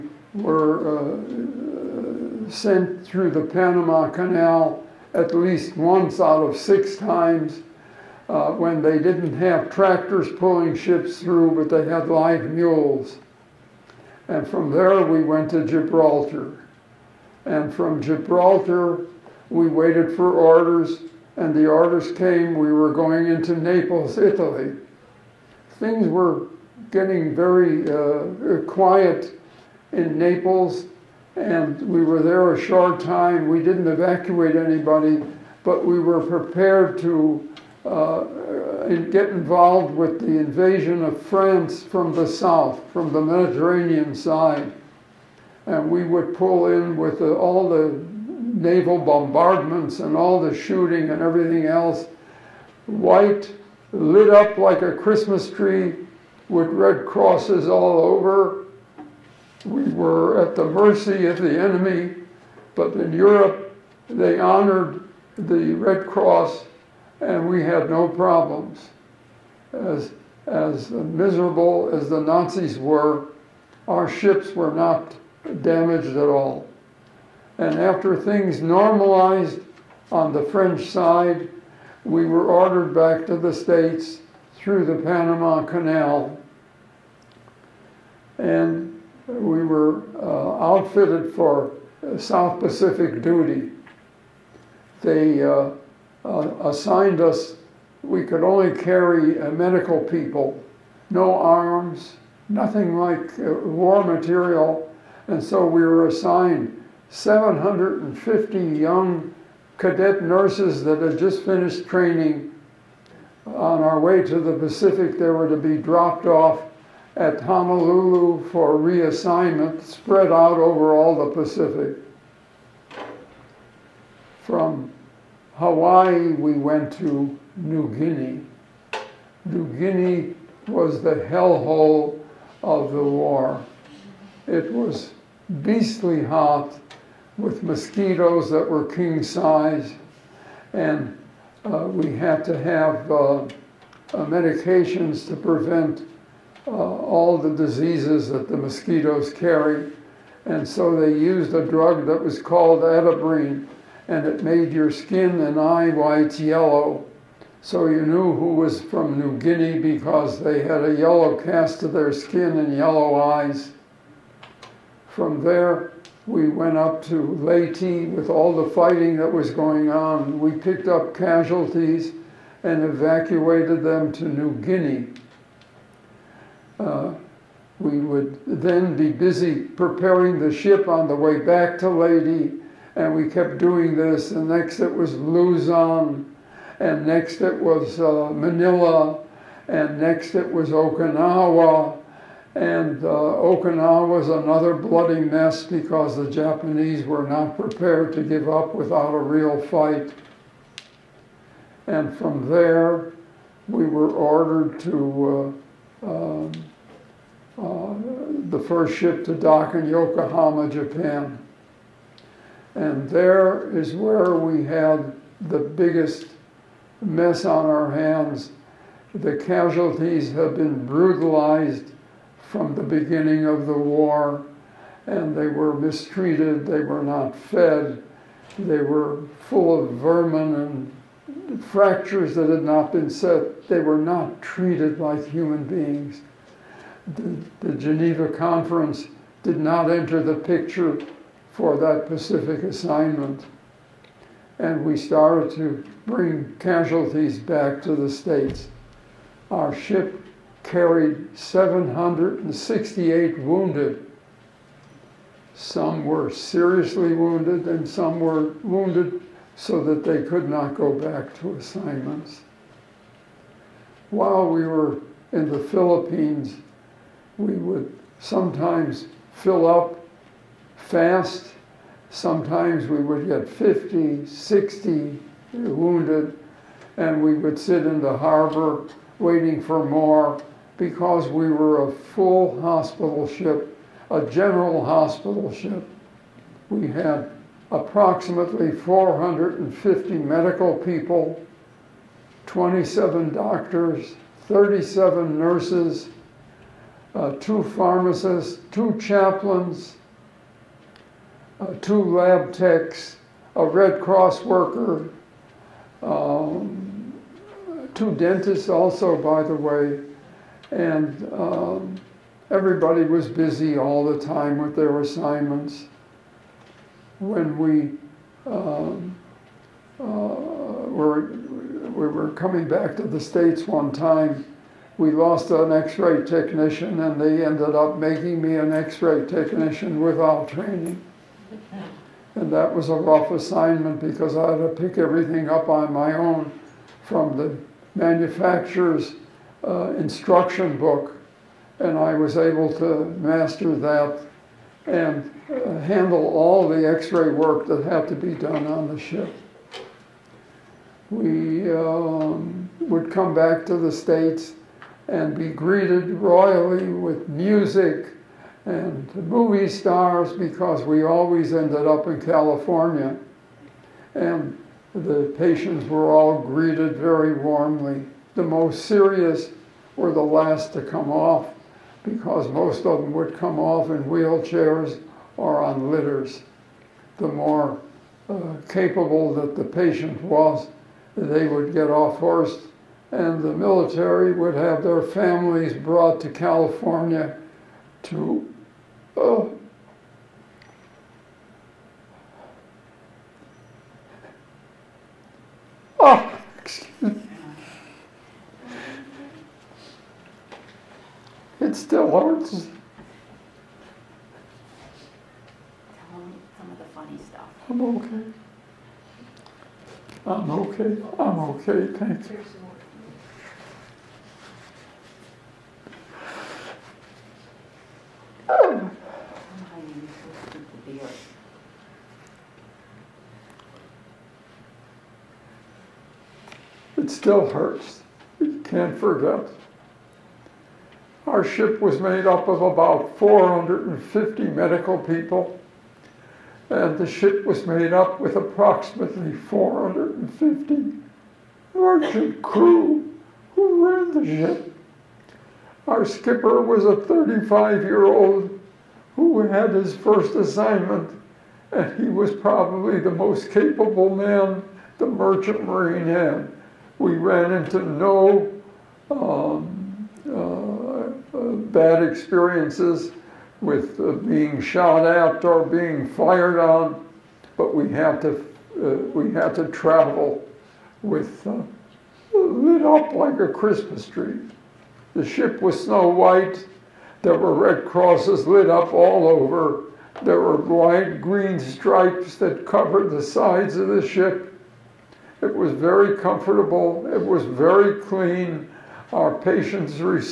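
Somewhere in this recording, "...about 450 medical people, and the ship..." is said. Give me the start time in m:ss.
7:12.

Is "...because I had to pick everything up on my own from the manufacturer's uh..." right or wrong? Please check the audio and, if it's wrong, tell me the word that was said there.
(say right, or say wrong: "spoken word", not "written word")
right.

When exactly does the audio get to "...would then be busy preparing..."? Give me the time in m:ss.
2:58.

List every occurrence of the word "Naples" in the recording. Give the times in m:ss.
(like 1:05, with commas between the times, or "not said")
0:23, 0:30.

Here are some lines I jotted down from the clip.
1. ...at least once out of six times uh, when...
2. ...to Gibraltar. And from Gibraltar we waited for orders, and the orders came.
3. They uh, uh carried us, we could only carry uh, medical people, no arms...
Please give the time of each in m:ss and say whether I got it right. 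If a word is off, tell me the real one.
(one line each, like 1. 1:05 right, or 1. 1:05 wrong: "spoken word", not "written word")
1. 0:05 right
2. 0:15 right
3. 1:35 wrong: "assigned", not "carried".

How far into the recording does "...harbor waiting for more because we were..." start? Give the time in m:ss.
4:38.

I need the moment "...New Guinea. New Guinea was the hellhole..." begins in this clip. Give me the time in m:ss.
2:07.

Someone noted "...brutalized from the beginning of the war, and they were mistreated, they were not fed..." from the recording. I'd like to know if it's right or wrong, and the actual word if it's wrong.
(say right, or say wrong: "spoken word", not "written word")
right.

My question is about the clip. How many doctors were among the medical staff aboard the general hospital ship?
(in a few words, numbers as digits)
27.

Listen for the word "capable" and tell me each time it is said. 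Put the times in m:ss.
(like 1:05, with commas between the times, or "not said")
6:18, 7:33.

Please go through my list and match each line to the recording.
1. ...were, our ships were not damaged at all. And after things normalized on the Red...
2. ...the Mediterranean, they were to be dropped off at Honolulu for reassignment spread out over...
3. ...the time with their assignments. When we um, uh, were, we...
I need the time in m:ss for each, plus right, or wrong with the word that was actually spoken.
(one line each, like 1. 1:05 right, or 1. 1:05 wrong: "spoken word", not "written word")
1. 1:12 wrong: "French", not "Red"
2. 1:54 wrong: "Pacific", not "Mediterranean"
3. 5:14 right.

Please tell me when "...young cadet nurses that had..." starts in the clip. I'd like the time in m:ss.
1:48.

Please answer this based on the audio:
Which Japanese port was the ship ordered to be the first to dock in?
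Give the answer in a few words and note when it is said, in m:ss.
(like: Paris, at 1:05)
Yokohama, at 3:29.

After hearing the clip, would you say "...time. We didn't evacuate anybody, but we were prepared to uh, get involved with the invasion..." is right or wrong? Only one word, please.
right.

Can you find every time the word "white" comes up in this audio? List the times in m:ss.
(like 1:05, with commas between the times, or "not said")
0:52, 2:35, 7:56.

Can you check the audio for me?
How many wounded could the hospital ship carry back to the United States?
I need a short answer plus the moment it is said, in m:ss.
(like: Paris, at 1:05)
768, at 4:11.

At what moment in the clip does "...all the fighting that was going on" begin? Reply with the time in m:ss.
2:48.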